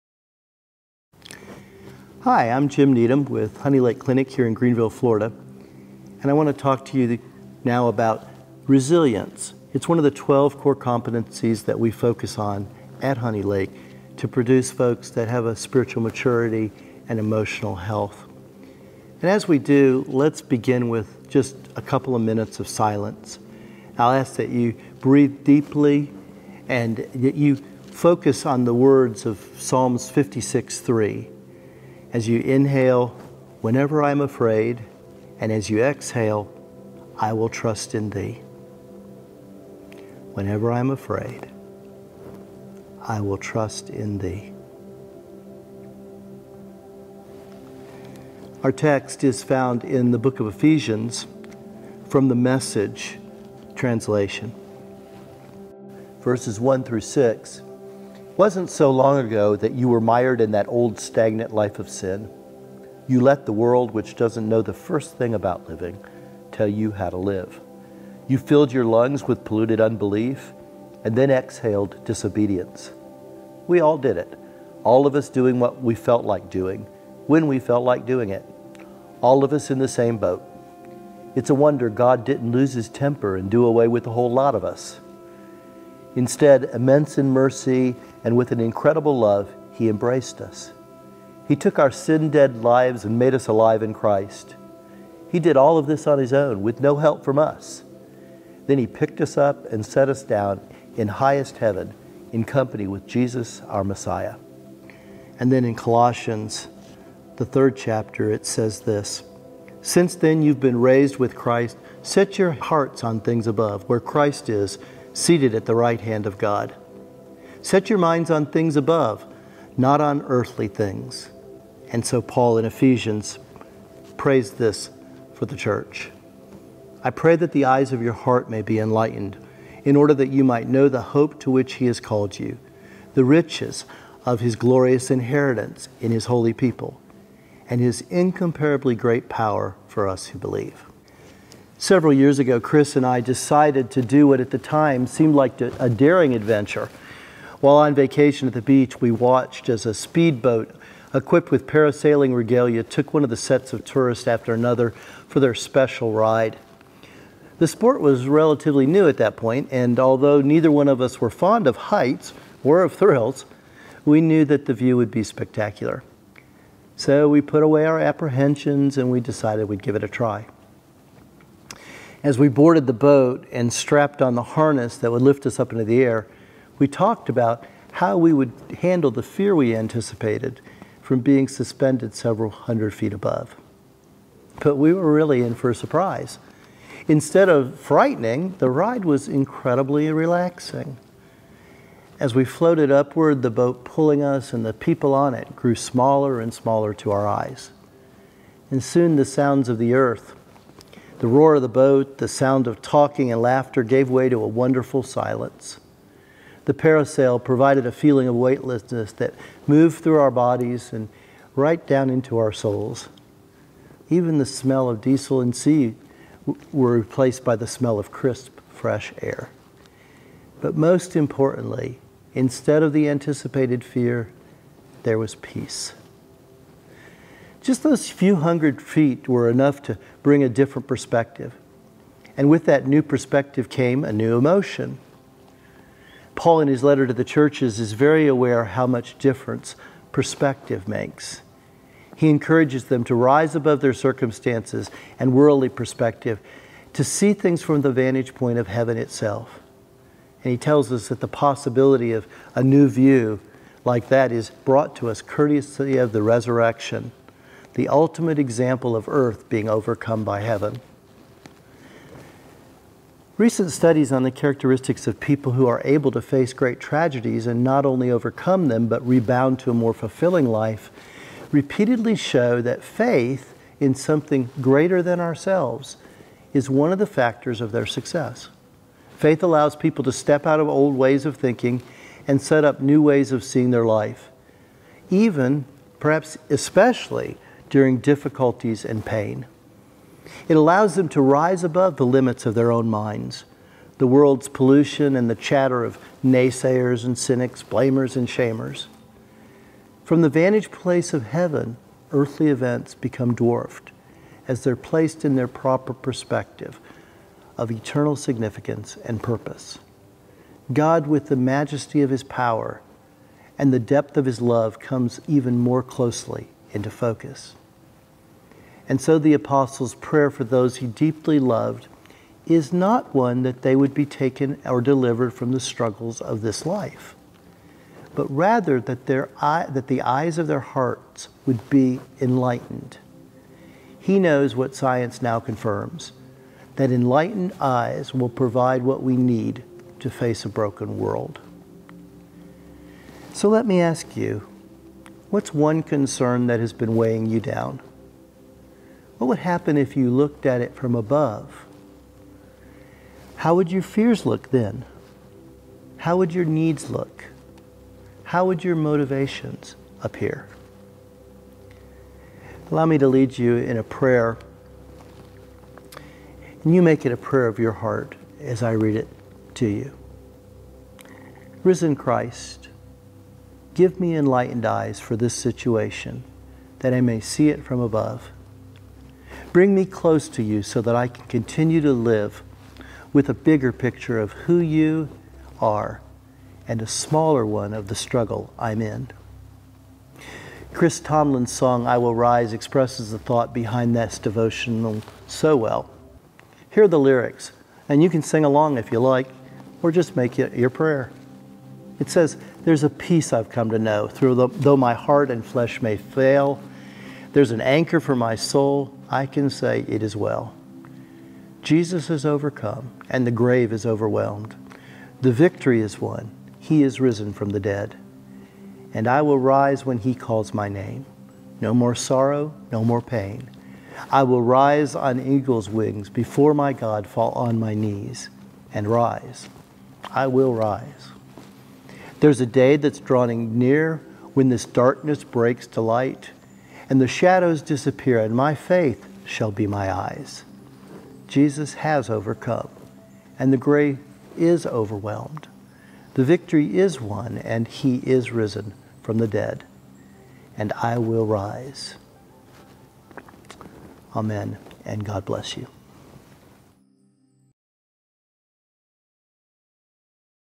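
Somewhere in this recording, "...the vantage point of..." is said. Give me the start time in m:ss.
4:07.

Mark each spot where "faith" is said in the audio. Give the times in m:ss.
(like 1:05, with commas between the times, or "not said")
4:32, 4:39, 7:18.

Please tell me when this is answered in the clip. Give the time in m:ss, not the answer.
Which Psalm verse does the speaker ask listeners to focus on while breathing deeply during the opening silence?
0:29.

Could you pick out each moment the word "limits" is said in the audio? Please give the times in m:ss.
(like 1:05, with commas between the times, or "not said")
4:52.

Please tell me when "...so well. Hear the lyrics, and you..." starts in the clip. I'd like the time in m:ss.
6:35.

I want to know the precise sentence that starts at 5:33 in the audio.
He knows what science now confirms that enlightened eyes will provide what we need to face a broken world.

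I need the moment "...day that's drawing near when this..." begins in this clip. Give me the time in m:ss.
7:12.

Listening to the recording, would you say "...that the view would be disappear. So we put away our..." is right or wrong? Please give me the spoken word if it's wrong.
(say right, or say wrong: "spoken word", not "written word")
wrong: "spectacular", not "disappear".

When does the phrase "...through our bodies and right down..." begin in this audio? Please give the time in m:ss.
3:30.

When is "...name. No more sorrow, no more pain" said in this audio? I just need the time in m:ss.
7:00.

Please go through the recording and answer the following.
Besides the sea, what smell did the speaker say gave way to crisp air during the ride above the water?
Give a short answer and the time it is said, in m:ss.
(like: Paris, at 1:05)
Diesel, at 3:34.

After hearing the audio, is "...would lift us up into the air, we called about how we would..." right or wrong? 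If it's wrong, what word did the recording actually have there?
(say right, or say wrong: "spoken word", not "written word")
wrong: "talked", not "called".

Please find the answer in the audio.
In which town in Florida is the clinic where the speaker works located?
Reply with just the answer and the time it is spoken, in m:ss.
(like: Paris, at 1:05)
Greenville, at 0:04.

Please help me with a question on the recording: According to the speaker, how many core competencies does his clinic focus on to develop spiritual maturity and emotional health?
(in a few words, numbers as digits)
12.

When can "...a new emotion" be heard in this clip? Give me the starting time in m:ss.
3:54.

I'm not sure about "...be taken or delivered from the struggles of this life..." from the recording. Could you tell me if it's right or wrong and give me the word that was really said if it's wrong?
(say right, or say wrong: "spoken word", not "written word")
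right.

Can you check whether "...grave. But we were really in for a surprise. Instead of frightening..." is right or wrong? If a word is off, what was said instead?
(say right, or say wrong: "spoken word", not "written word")
wrong: "above", not "grave".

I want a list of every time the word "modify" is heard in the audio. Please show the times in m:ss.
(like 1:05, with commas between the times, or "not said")
not said.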